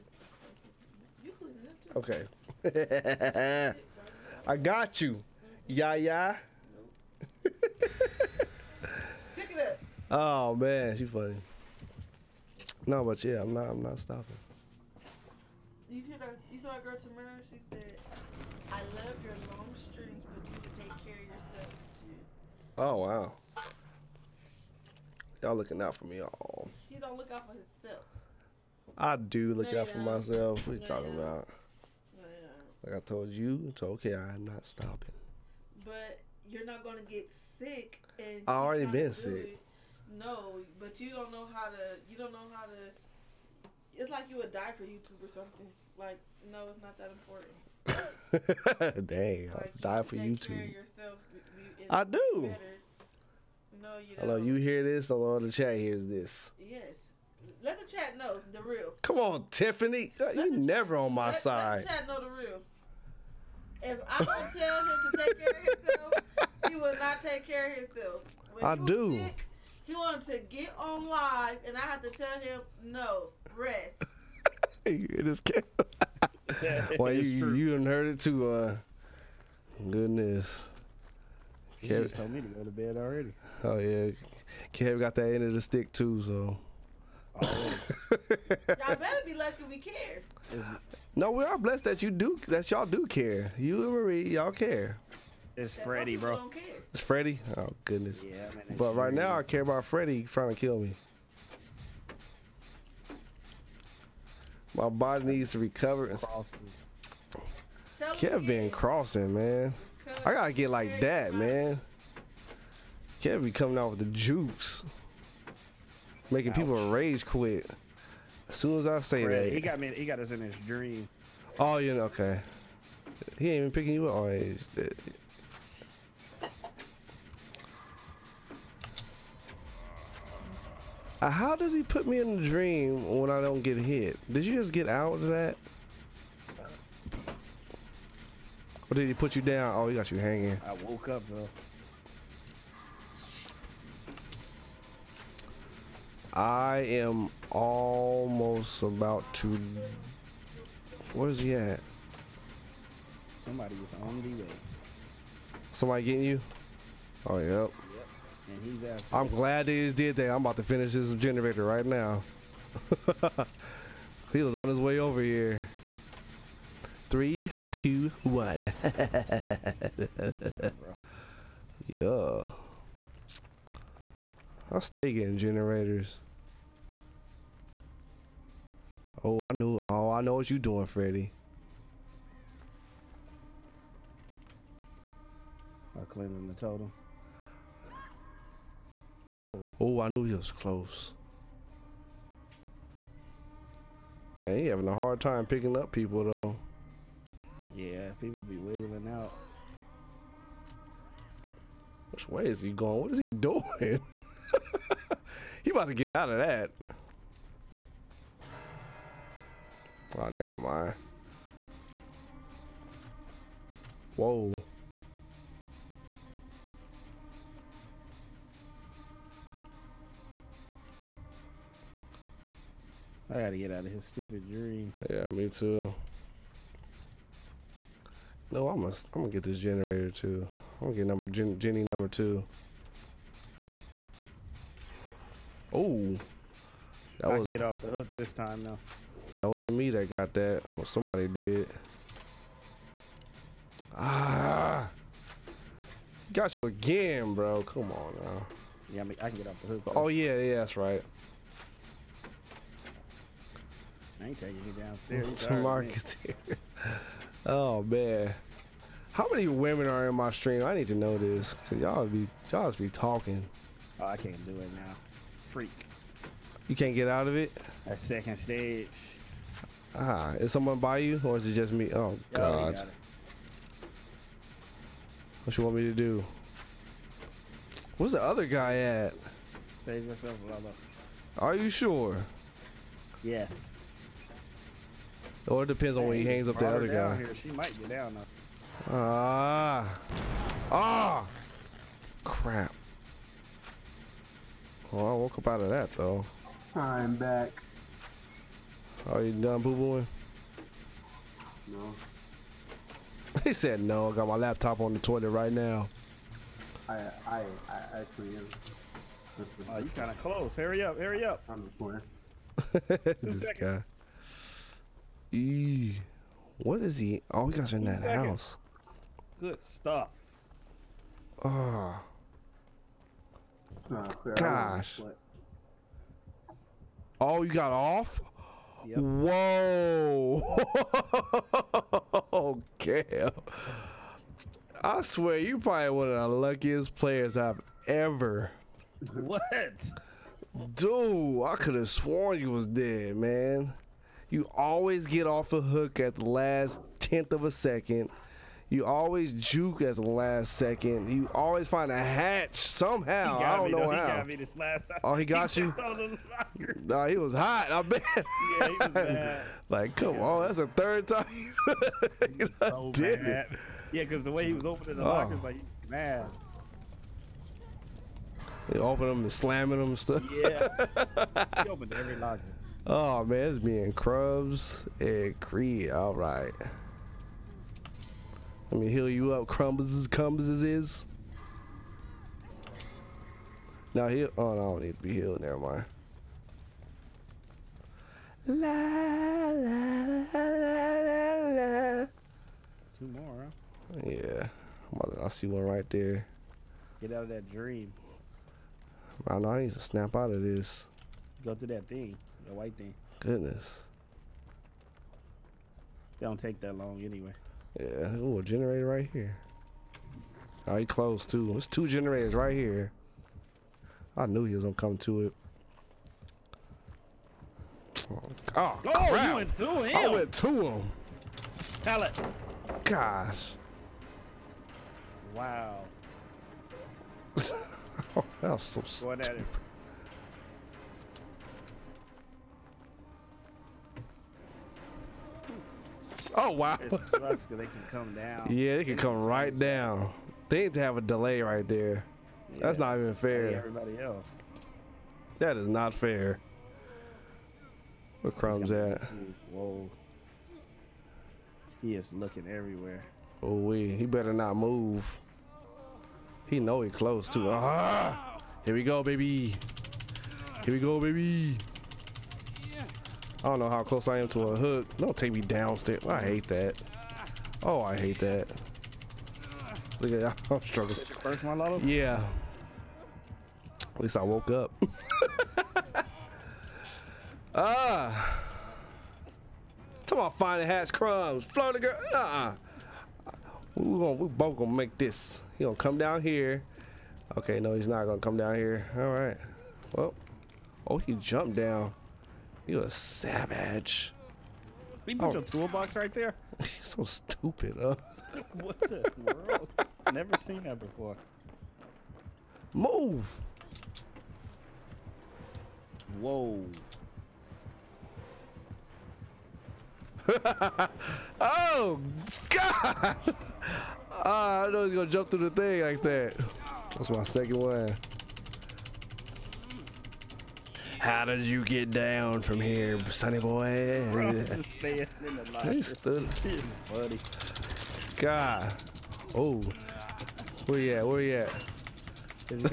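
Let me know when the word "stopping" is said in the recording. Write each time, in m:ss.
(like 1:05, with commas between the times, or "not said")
0:13, 0:34.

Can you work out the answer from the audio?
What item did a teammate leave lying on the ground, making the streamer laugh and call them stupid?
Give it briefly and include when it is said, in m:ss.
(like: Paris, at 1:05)
Toolbox, at 8:15.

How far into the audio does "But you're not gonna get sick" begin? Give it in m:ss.
0:35.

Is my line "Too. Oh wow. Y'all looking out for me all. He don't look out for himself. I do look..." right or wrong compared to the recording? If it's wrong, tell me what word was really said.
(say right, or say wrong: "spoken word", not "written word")
right.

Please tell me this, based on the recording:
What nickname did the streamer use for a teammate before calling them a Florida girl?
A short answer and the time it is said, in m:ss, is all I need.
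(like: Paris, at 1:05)
Crumbs, at 8:00.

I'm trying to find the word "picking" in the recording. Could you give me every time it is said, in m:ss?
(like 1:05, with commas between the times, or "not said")
2:03, 3:15.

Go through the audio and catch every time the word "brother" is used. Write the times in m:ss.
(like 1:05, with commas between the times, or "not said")
4:40.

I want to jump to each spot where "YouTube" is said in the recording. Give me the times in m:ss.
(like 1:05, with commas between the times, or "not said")
0:44, 0:50.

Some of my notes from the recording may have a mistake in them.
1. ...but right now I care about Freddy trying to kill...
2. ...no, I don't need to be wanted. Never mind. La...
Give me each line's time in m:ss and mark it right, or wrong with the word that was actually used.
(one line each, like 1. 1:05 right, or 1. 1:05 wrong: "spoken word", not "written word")
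1. 1:38 right
2. 6:24 wrong: "healed", not "wanted".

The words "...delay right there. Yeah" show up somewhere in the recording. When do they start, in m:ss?
7:21.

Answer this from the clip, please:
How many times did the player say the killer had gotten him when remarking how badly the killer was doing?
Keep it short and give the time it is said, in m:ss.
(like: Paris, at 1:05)
Third time, at 6:00.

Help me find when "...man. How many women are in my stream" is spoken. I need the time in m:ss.
4:17.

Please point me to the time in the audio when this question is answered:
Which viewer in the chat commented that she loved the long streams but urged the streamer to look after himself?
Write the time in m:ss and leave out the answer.
0:16.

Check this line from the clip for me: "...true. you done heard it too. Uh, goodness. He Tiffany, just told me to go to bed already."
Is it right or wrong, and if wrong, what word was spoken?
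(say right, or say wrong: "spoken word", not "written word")
wrong: "Kev", not "Tiffany".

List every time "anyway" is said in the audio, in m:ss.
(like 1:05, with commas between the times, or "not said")
6:47.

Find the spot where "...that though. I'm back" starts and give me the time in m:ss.
4:55.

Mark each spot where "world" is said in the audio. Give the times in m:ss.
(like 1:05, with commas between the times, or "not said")
8:19.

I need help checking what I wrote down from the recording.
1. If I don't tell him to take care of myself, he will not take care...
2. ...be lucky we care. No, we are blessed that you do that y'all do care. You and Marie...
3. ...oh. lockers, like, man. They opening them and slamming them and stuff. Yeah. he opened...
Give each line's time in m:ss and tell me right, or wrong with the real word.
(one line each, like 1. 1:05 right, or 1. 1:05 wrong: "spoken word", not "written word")
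1. 1:03 wrong: "himself", not "myself"
2. 1:29 right
3. 6:05 right.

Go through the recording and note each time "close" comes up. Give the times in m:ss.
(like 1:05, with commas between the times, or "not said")
3:10, 5:10, 6:50, 7:36, 7:43.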